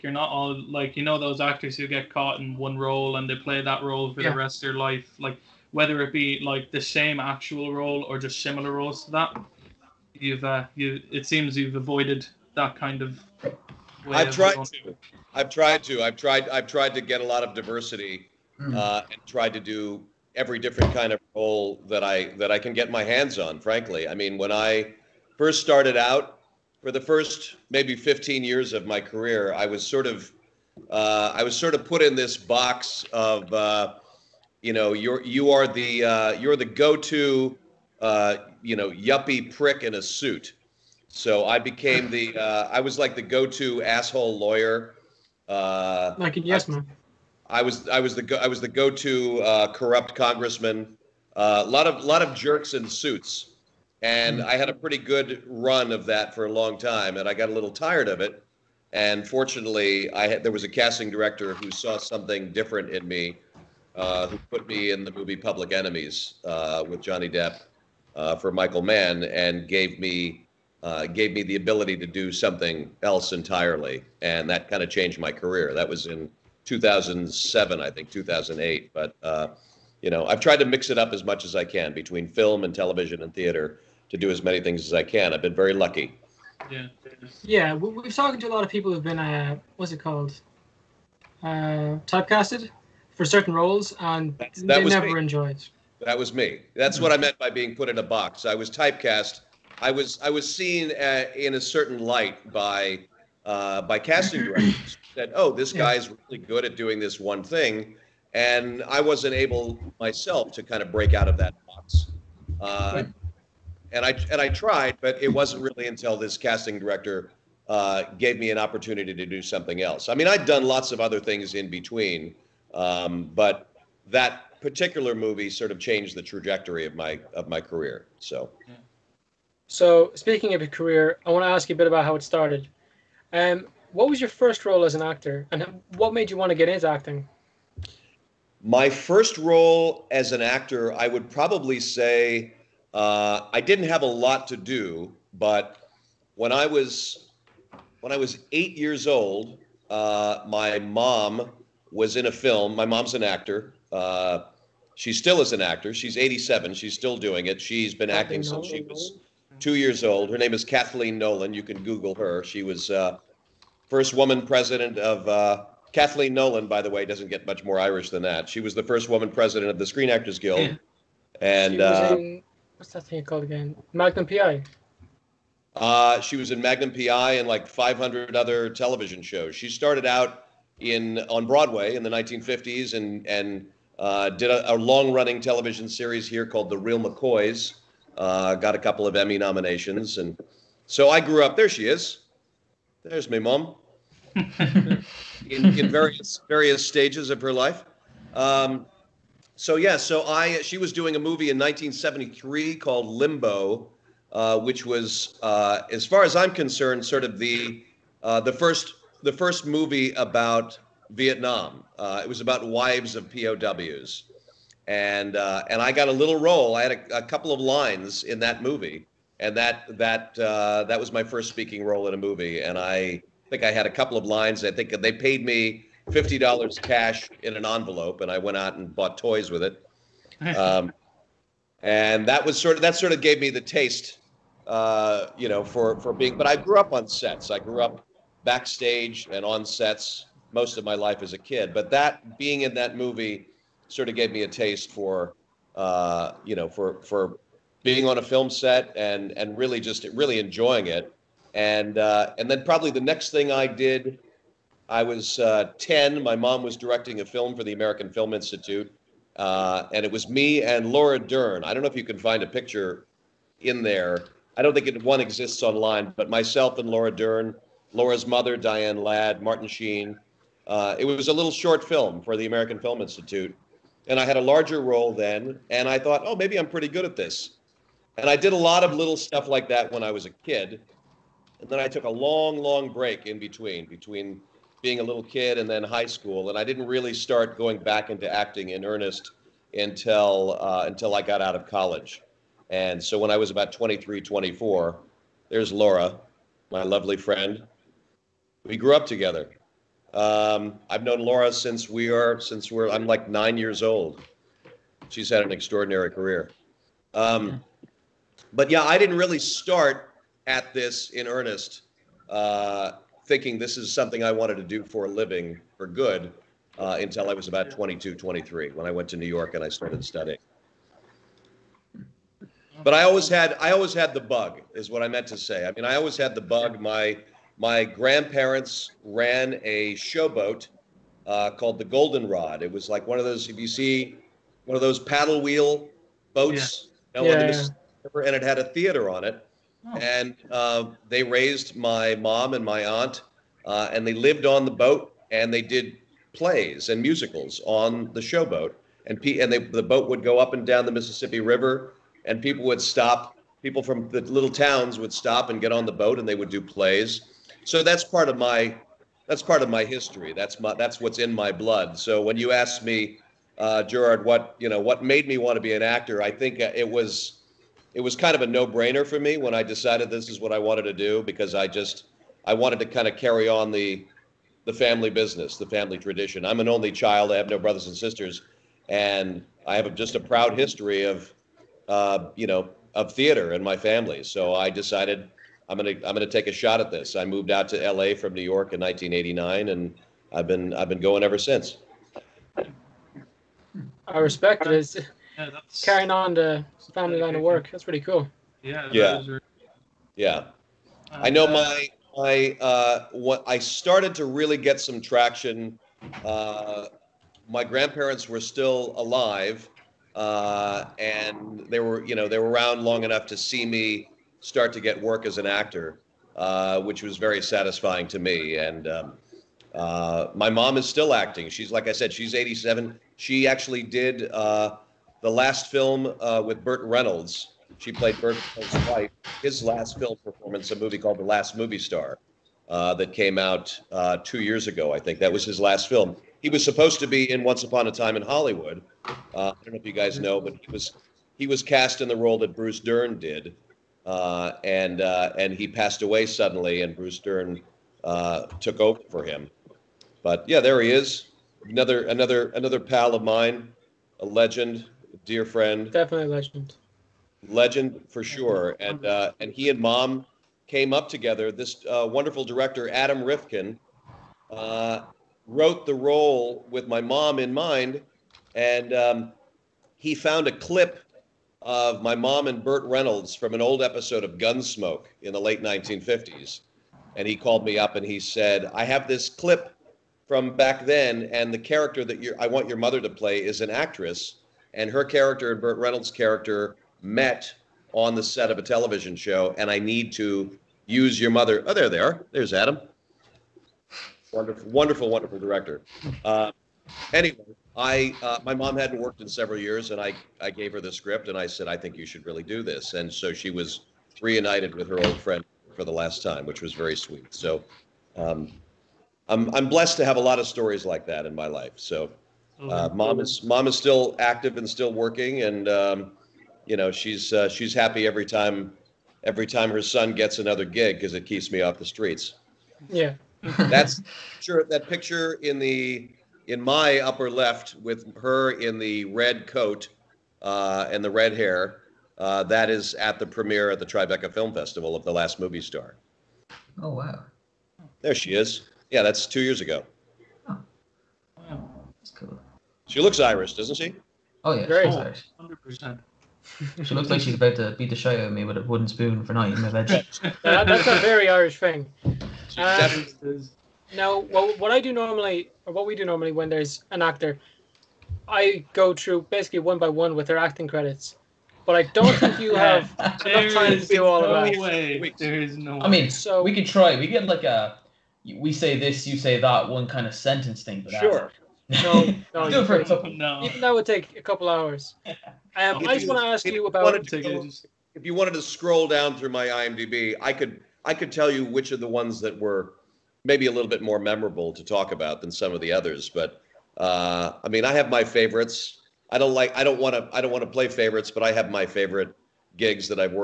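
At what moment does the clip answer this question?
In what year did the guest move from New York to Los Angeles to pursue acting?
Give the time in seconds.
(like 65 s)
388 s.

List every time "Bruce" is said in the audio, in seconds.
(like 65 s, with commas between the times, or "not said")
442 s, 446 s.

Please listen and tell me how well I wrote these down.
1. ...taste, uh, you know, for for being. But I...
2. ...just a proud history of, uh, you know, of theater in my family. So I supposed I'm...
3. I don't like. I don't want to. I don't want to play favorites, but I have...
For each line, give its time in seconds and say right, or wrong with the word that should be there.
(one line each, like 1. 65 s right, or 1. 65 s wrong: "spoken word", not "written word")
1. 233 s right
2. 379 s wrong: "decided", not "supposed"
3. 589 s right.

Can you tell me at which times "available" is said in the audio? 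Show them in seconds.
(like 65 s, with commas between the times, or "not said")
not said.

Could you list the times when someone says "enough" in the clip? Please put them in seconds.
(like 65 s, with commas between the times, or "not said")
413 s, 562 s.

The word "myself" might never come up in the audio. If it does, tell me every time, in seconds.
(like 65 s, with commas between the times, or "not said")
109 s, 266 s.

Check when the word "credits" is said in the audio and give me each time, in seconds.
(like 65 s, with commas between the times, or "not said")
560 s.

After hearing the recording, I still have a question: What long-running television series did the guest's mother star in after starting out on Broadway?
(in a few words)
The Real McCoys.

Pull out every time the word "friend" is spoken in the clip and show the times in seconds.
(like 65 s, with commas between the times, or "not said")
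297 s, 455 s, 505 s.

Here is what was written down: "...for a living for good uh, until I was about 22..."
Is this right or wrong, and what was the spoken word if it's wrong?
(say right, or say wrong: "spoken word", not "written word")
right.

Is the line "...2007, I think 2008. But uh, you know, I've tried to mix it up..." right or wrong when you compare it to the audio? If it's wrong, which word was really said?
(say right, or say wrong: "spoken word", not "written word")
right.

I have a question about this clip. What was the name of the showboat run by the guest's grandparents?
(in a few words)
Goldenrod.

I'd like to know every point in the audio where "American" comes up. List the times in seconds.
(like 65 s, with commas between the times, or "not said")
257 s, 272 s.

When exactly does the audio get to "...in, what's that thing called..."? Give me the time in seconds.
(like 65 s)
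172 s.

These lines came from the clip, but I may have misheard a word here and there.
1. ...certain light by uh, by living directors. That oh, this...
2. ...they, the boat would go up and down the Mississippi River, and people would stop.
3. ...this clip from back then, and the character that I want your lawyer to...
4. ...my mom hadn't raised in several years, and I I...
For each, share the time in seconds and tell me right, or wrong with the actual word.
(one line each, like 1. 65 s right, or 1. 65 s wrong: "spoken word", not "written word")
1. 101 s wrong: "casting", not "living"
2. 349 s right
3. 479 s wrong: "mother", not "lawyer"
4. 498 s wrong: "worked", not "raised".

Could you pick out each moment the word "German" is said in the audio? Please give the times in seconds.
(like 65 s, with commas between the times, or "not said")
not said.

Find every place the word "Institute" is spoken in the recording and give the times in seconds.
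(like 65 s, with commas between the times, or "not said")
258 s, 273 s.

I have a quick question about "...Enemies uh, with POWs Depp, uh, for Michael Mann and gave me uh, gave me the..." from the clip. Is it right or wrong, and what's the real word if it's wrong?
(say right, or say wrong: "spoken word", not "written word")
wrong: "Johnny", not "POWs".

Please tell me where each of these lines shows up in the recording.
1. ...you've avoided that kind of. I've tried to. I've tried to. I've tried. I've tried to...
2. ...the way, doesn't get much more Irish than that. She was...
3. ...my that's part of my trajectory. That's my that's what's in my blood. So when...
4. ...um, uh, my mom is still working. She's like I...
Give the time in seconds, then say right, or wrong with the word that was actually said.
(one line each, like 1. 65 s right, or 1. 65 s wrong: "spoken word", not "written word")
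1. 11 s right
2. 166 s right
3. 358 s wrong: "history", not "trajectory"
4. 418 s wrong: "acting", not "working".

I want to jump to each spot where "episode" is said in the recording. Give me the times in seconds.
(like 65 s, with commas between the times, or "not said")
473 s.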